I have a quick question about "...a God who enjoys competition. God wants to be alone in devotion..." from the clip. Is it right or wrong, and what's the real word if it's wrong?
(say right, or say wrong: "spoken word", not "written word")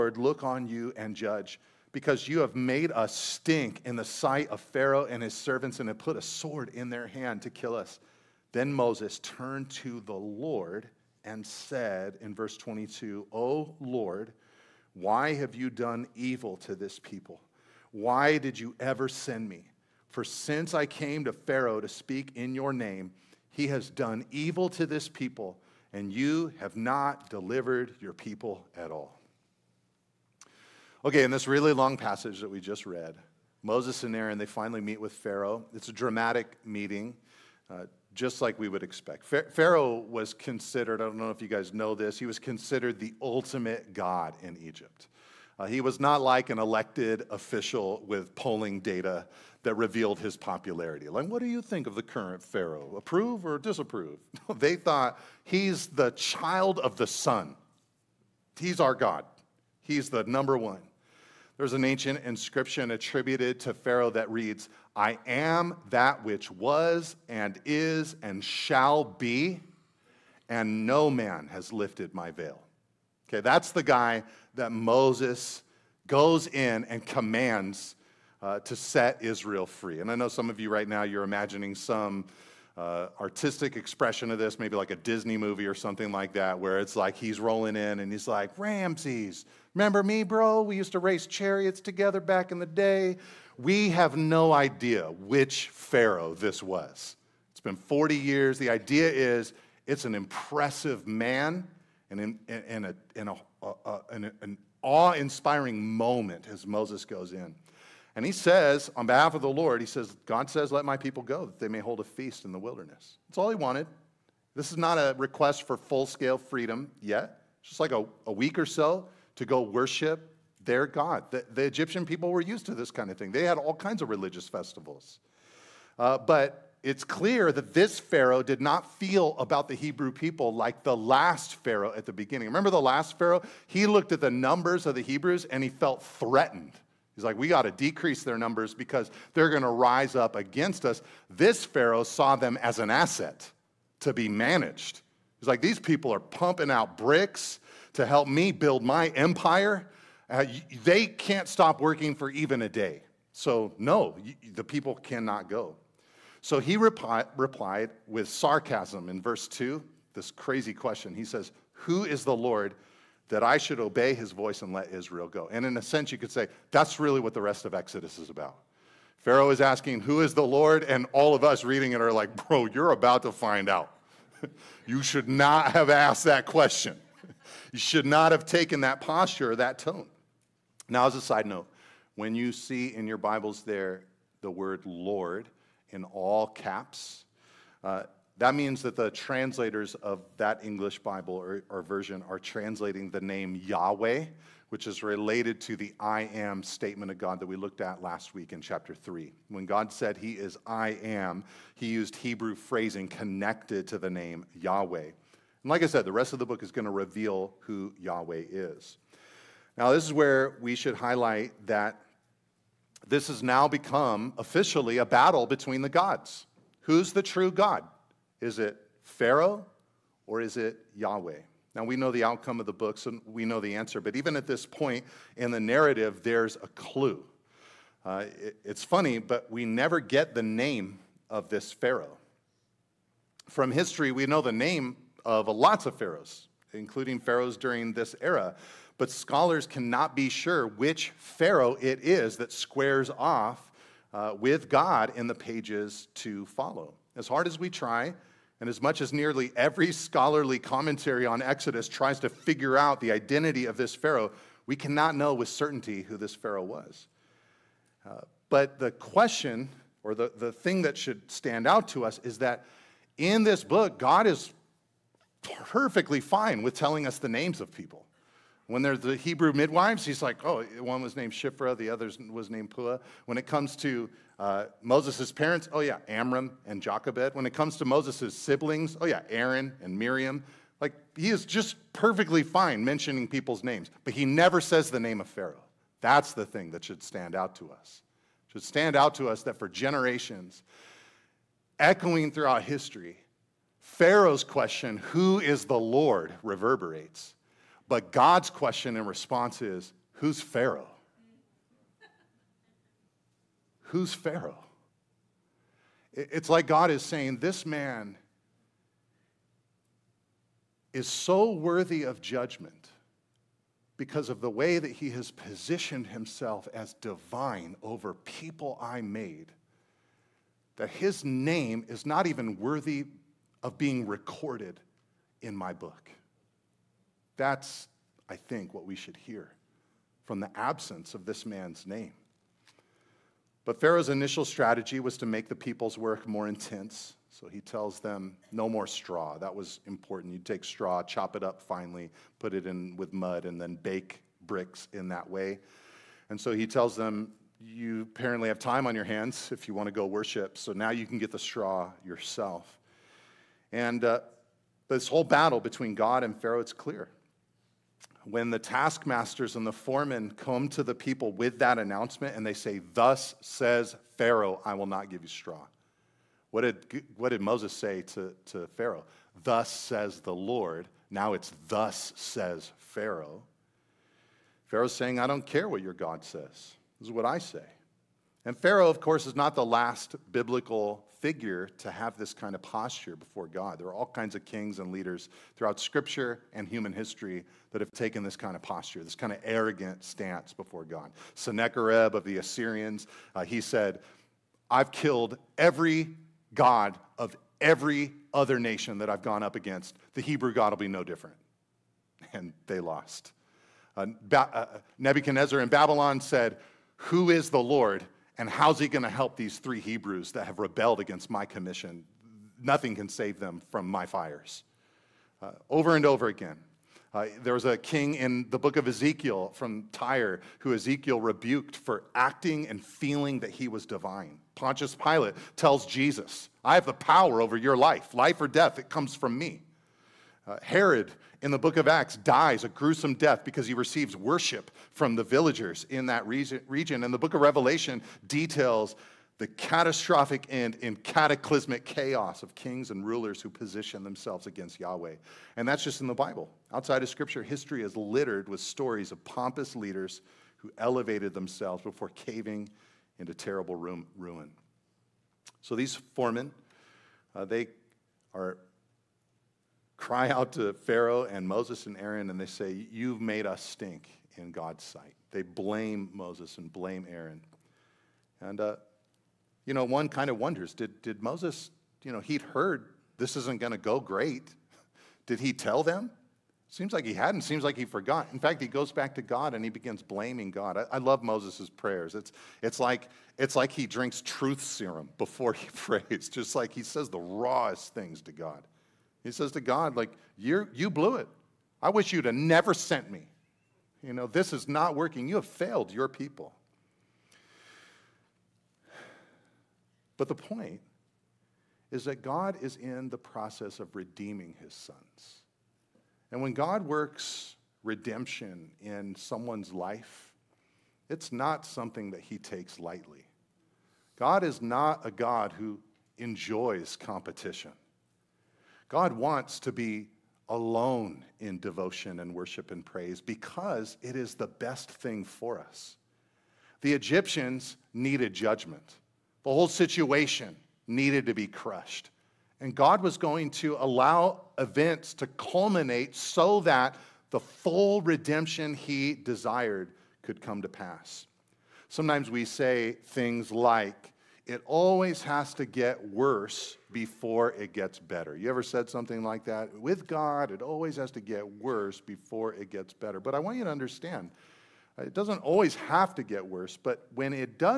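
right.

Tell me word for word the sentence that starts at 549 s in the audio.
With God, it always has to get worse before it gets better.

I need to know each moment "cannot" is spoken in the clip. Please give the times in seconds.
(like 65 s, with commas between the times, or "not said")
154 s, 239 s, 254 s.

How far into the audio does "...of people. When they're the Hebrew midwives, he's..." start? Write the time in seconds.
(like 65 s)
267 s.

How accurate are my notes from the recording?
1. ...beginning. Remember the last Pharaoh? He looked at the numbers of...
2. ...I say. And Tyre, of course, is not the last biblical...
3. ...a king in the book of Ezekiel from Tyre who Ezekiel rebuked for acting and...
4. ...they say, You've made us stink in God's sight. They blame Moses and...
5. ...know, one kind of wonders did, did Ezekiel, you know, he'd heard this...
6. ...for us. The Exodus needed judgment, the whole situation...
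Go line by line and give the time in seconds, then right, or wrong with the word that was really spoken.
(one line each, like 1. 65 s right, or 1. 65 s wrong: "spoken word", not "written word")
1. 132 s right
2. 377 s wrong: "Pharaoh", not "Tyre"
3. 417 s right
4. 462 s right
5. 469 s wrong: "Moses", not "Ezekiel"
6. 525 s wrong: "Egyptians", not "Exodus".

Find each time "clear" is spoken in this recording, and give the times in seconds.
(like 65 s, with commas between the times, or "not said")
127 s, 356 s.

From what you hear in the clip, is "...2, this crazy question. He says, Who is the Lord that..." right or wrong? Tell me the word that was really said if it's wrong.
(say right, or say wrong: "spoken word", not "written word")
right.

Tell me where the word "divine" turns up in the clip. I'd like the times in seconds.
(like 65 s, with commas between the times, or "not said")
316 s, 423 s.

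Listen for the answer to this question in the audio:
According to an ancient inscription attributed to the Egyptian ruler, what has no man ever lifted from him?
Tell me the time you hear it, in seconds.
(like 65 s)
72 s.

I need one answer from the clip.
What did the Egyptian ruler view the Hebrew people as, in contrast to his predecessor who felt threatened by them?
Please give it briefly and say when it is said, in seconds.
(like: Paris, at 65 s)
an asset, at 142 s.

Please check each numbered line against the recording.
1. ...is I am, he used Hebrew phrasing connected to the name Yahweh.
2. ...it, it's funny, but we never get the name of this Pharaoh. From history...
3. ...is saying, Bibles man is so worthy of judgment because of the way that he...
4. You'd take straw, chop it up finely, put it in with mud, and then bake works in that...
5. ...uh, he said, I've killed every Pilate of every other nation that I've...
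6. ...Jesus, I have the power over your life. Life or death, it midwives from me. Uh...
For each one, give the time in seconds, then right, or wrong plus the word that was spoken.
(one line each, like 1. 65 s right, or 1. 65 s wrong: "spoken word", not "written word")
1. 200 s right
2. 228 s right
3. 306 s wrong: "This", not "Bibles"
4. 340 s wrong: "bricks", not "works"
5. 393 s wrong: "God", not "Pilate"
6. 425 s wrong: "comes", not "midwives".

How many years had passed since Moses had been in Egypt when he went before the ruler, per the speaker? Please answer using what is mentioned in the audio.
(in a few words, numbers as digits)
40.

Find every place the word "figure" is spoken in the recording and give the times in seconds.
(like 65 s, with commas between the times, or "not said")
252 s, 381 s.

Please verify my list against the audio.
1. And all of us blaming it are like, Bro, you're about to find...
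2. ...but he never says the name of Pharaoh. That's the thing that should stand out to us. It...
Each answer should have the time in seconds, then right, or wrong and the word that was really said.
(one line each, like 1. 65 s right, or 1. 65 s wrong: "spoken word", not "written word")
1. 170 s wrong: "reading", not "blaming"
2. 284 s right.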